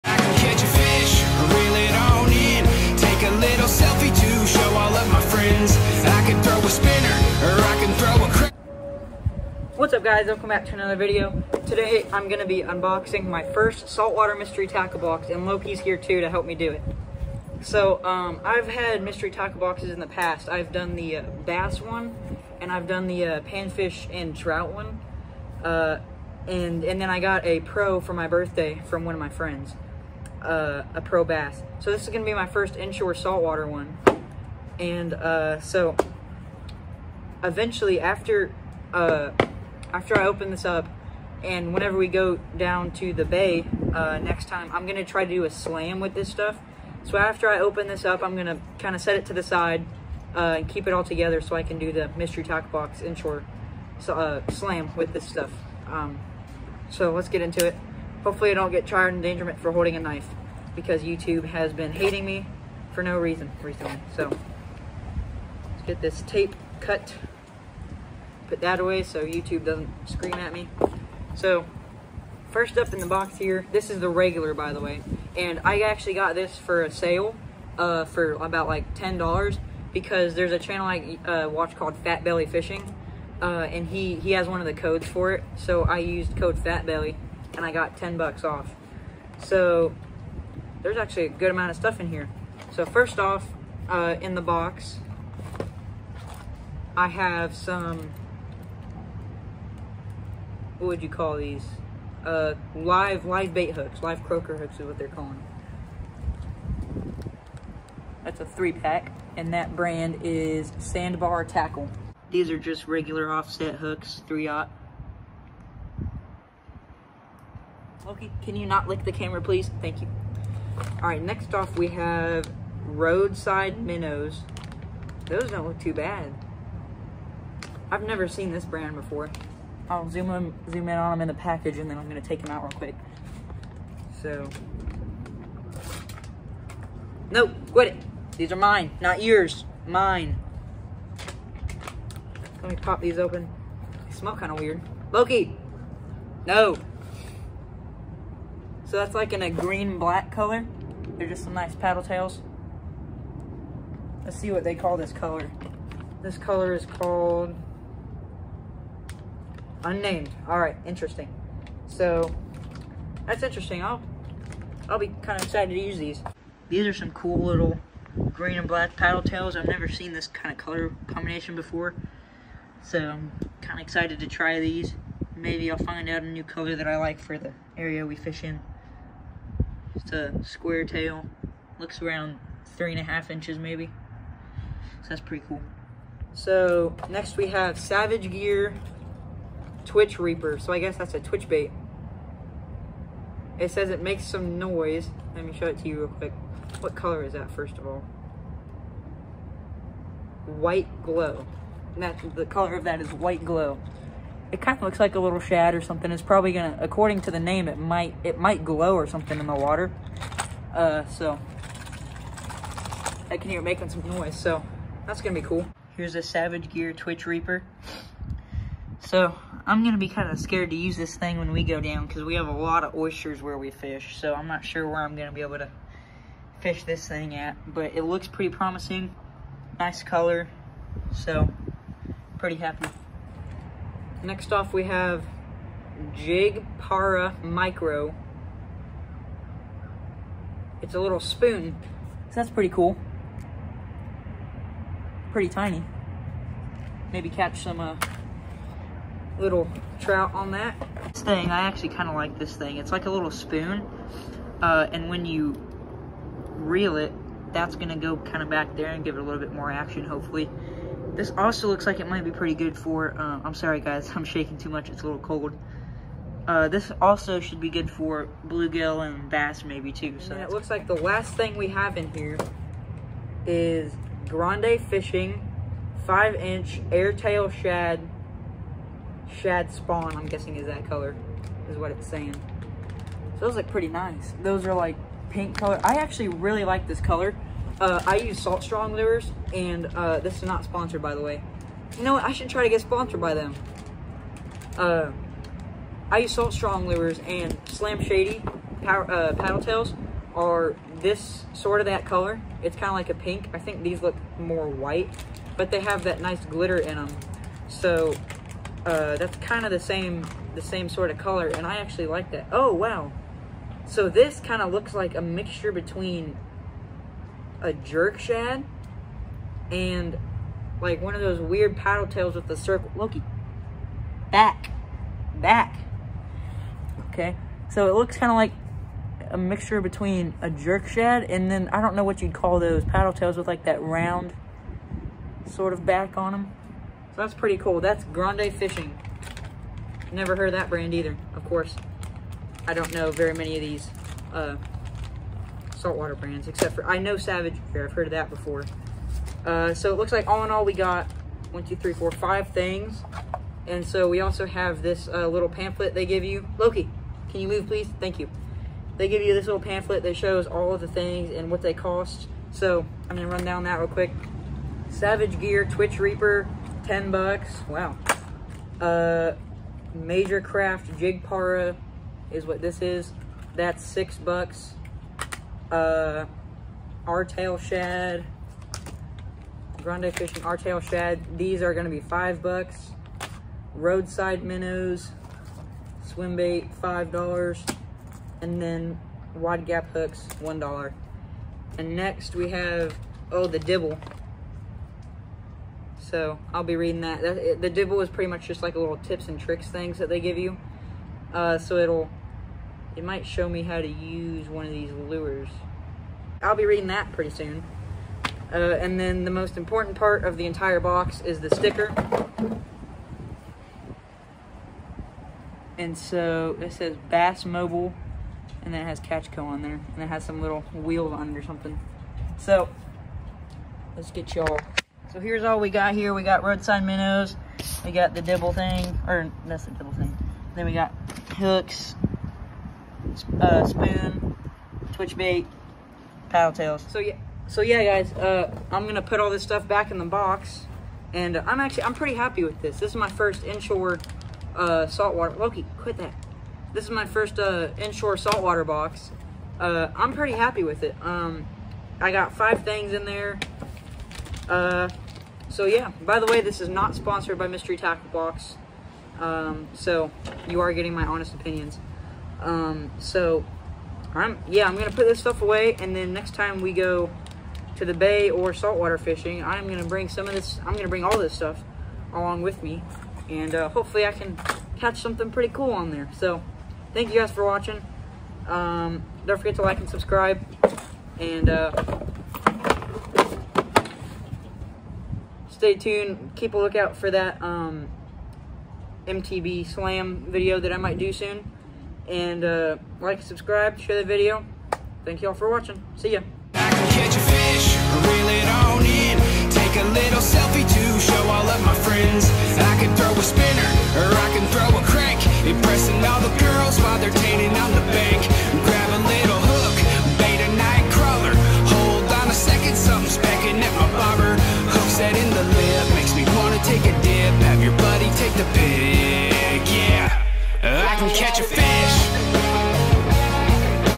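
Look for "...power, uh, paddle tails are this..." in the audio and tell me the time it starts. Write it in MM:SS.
04:58.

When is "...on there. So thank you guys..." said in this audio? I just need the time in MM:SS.
07:55.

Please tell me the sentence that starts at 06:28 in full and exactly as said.
And then Wide Gap Hooks, one dollar.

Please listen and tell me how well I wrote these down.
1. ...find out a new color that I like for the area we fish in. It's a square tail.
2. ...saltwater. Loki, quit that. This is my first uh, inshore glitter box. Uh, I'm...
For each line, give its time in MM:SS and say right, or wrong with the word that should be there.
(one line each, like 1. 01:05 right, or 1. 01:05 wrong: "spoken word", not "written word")
1. 02:55 right
2. 07:24 wrong: "saltwater", not "glitter".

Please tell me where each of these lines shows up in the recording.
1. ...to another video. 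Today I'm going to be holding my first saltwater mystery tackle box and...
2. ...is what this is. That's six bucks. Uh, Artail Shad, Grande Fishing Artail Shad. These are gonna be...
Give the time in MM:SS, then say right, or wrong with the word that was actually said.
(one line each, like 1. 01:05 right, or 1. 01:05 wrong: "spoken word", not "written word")
1. 00:10 wrong: "unboxing", not "holding"
2. 06:12 right.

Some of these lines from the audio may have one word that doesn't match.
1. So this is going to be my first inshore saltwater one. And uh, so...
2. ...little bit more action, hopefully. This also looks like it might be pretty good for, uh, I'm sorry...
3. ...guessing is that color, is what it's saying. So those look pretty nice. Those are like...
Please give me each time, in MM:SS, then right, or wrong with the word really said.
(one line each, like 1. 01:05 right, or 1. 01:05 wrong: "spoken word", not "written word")
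1. 00:31 right
2. 04:19 right
3. 04:40 right.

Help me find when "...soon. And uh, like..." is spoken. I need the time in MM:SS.
08:11.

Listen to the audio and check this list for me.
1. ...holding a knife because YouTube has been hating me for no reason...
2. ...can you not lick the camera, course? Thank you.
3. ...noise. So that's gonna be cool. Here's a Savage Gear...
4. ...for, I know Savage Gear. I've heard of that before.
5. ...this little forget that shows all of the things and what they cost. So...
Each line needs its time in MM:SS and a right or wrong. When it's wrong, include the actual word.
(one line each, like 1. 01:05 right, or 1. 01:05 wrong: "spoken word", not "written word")
1. 00:59 right
2. 01:58 wrong: "please", not "course"
3. 03:34 right
4. 05:46 right
5. 05:59 wrong: "pamphlet", not "forget".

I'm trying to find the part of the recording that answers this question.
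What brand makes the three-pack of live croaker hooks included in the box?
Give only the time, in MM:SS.
01:50.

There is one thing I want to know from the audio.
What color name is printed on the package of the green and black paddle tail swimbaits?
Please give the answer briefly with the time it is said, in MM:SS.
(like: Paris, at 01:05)
Unnamed, at 02:39.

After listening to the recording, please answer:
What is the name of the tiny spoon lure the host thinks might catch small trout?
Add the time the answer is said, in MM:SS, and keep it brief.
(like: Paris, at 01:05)
Jig Para Micro, at 03:56.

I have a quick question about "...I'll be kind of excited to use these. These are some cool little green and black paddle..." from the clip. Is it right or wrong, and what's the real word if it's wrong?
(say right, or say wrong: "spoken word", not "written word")
right.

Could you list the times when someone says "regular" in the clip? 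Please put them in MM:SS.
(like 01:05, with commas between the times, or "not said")
01:14, 01:52.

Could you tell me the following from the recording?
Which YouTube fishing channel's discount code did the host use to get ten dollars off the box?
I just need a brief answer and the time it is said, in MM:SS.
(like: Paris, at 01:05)
Fat Belly Fishing, at 01:22.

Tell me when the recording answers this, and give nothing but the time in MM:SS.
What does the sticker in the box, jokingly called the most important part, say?
06:57.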